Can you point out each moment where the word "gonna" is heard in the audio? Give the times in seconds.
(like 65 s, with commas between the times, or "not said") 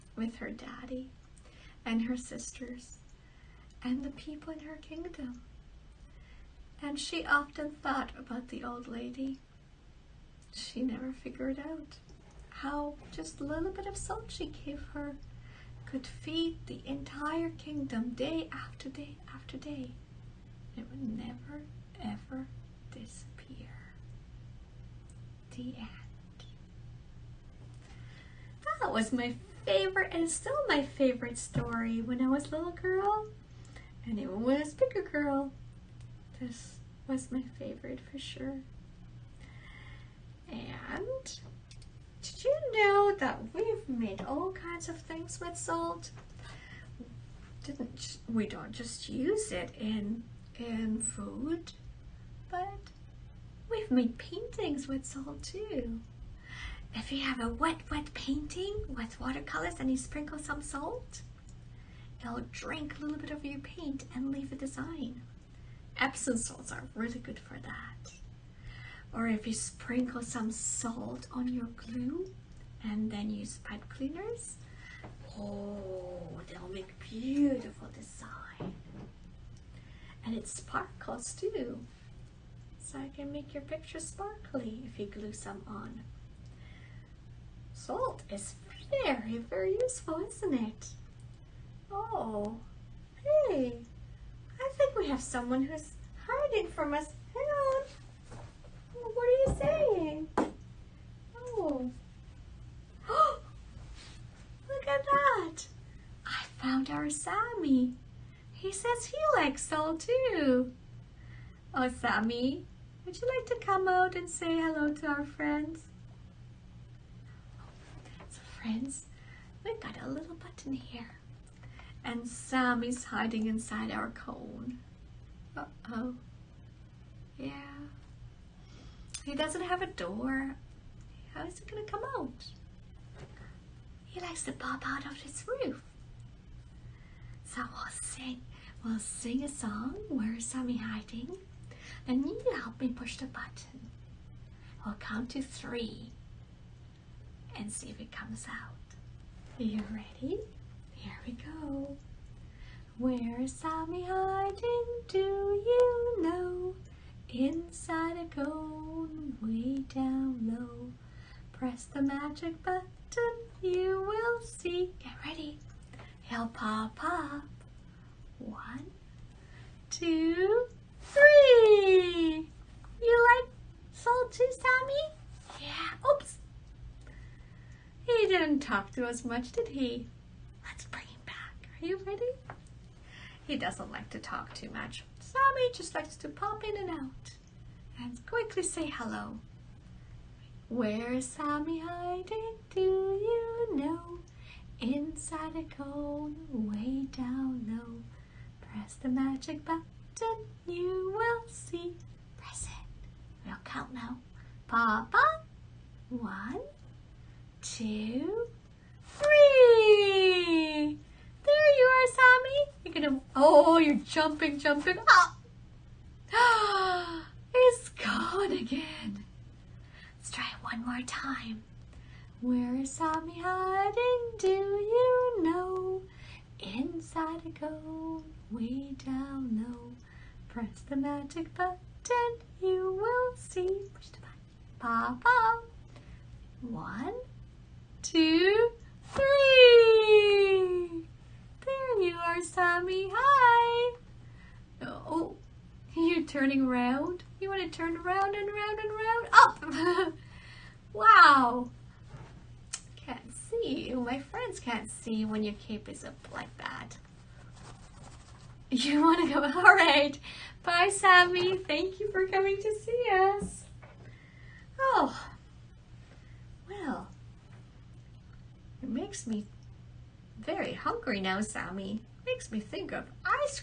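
131 s, 213 s.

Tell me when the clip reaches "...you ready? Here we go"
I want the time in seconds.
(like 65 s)
149 s.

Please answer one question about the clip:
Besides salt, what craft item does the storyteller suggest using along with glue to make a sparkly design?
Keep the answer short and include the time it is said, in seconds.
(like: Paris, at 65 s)
Pipe cleaners, at 73 s.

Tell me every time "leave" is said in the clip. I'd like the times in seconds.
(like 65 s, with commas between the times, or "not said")
64 s.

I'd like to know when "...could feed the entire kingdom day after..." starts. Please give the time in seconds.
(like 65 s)
15 s.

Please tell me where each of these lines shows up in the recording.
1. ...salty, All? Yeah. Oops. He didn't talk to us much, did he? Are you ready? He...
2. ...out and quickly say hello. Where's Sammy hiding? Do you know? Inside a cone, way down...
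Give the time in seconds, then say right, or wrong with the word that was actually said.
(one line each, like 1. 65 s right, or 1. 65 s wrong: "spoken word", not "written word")
1. 173 s wrong: "Sammy", not "All"
2. 186 s right.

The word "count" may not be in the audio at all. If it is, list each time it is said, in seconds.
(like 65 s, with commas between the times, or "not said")
144 s, 203 s.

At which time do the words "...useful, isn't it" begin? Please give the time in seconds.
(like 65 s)
89 s.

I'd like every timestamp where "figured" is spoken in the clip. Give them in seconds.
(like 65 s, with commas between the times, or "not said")
11 s.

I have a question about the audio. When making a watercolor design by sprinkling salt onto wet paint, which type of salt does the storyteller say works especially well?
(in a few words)
Epsom salts.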